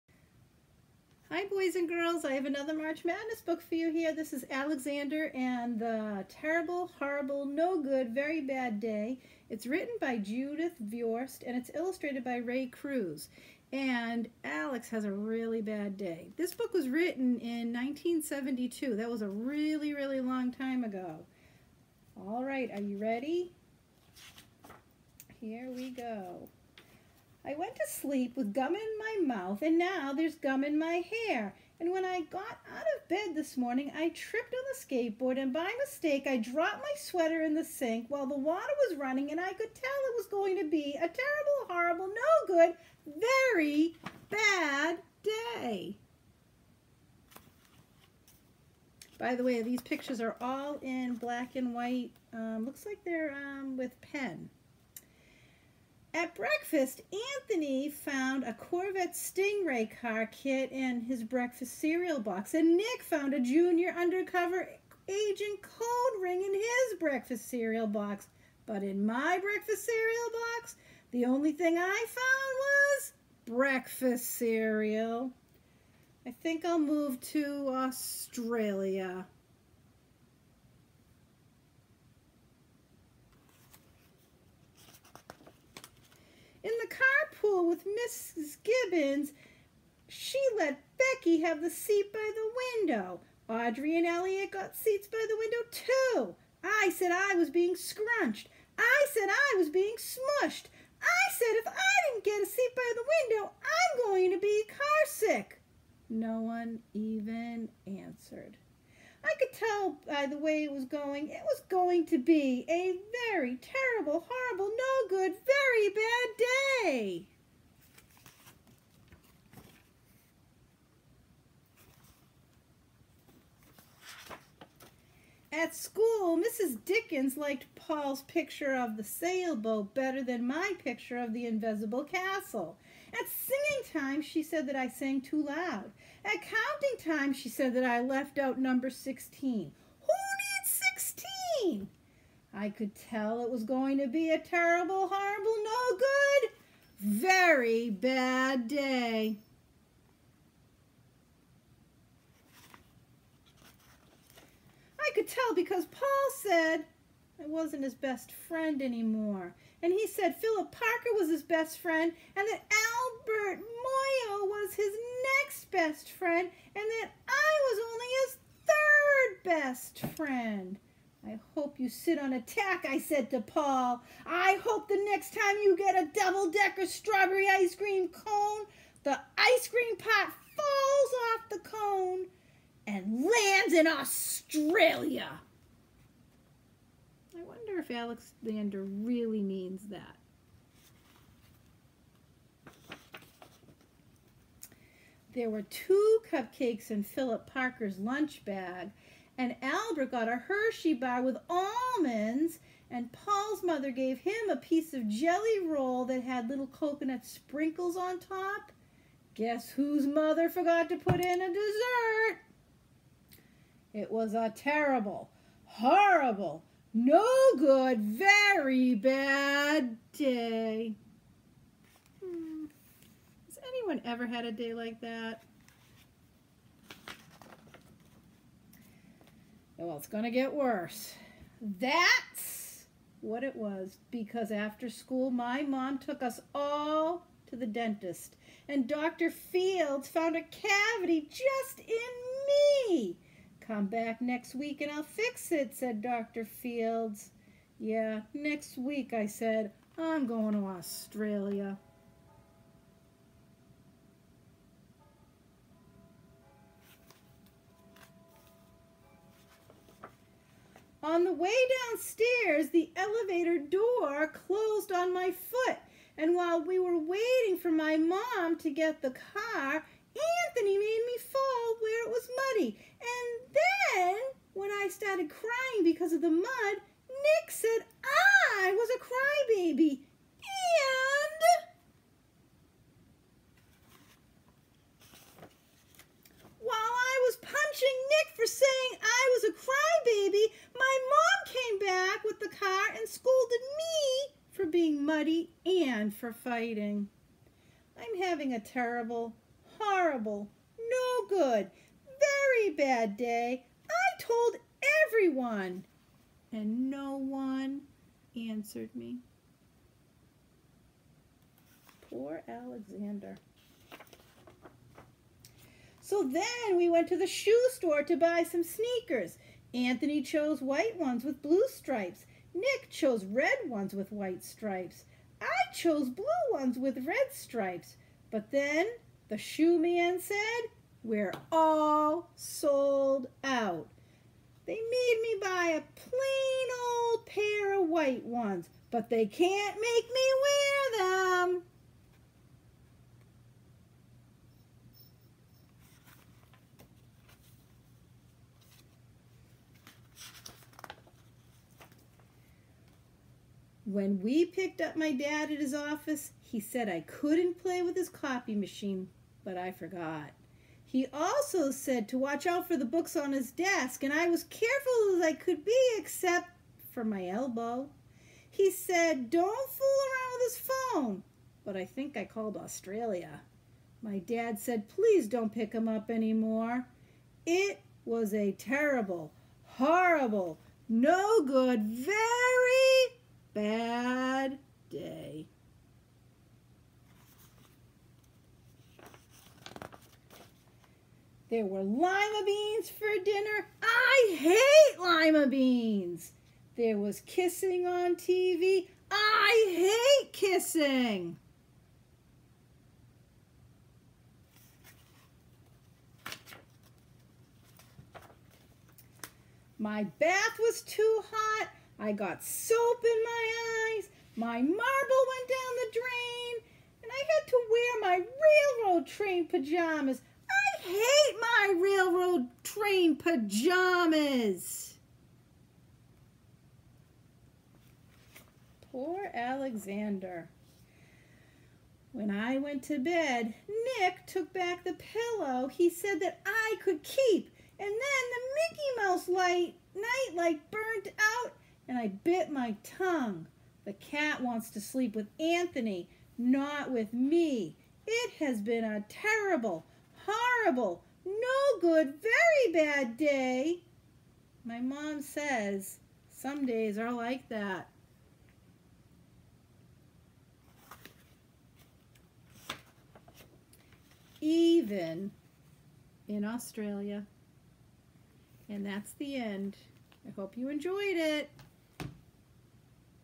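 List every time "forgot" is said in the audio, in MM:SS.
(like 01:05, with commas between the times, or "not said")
03:30, 05:59.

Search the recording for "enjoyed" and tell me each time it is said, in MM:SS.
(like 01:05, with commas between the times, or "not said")
07:50.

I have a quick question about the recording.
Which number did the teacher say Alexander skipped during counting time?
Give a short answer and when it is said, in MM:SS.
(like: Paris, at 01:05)
16, at 02:18.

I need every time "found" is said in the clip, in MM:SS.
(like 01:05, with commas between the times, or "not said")
00:57, 01:03, 01:12, 04:00.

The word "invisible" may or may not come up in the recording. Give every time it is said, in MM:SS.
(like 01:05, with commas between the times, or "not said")
02:11.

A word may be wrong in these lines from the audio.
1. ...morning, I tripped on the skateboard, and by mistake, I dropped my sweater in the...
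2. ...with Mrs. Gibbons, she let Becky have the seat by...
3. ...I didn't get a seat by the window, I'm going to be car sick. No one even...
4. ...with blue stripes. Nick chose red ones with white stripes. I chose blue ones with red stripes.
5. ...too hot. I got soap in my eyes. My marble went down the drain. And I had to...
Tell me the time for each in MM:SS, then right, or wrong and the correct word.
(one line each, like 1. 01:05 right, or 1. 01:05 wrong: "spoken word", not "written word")
1. 00:33 right
2. 01:27 right
3. 01:41 right
4. 05:21 right
5. 06:50 right.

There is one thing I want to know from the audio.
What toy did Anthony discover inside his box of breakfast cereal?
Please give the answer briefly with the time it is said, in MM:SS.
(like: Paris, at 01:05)
Corvette Stingray car kit, at 00:58.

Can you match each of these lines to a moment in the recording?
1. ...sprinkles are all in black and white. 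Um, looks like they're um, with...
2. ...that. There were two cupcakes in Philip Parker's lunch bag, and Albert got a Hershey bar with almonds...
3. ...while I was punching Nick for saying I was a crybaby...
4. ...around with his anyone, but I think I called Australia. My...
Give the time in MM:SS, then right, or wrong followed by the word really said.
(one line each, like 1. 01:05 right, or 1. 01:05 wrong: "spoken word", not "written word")
1. 00:49 wrong: "pictures", not "sprinkles"
2. 03:09 right
3. 04:46 right
4. 06:10 wrong: "phone", not "anyone".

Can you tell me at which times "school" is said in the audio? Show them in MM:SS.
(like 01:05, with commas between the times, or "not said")
01:27, 02:05, 03:54.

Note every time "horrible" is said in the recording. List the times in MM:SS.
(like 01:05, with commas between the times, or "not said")
00:06, 00:41, 01:54, 02:25, 03:35, 04:59, 06:19, 07:30.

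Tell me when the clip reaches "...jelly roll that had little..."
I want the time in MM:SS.
03:25.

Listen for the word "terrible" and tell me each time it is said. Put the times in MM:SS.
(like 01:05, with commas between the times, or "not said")
00:06, 00:41, 01:53, 02:24, 03:34, 04:58, 06:18, 07:29.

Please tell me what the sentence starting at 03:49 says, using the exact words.
Well, it's going to get worse.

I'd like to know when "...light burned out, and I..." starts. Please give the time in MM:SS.
07:20.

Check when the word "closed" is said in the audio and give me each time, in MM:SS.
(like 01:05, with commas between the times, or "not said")
04:24.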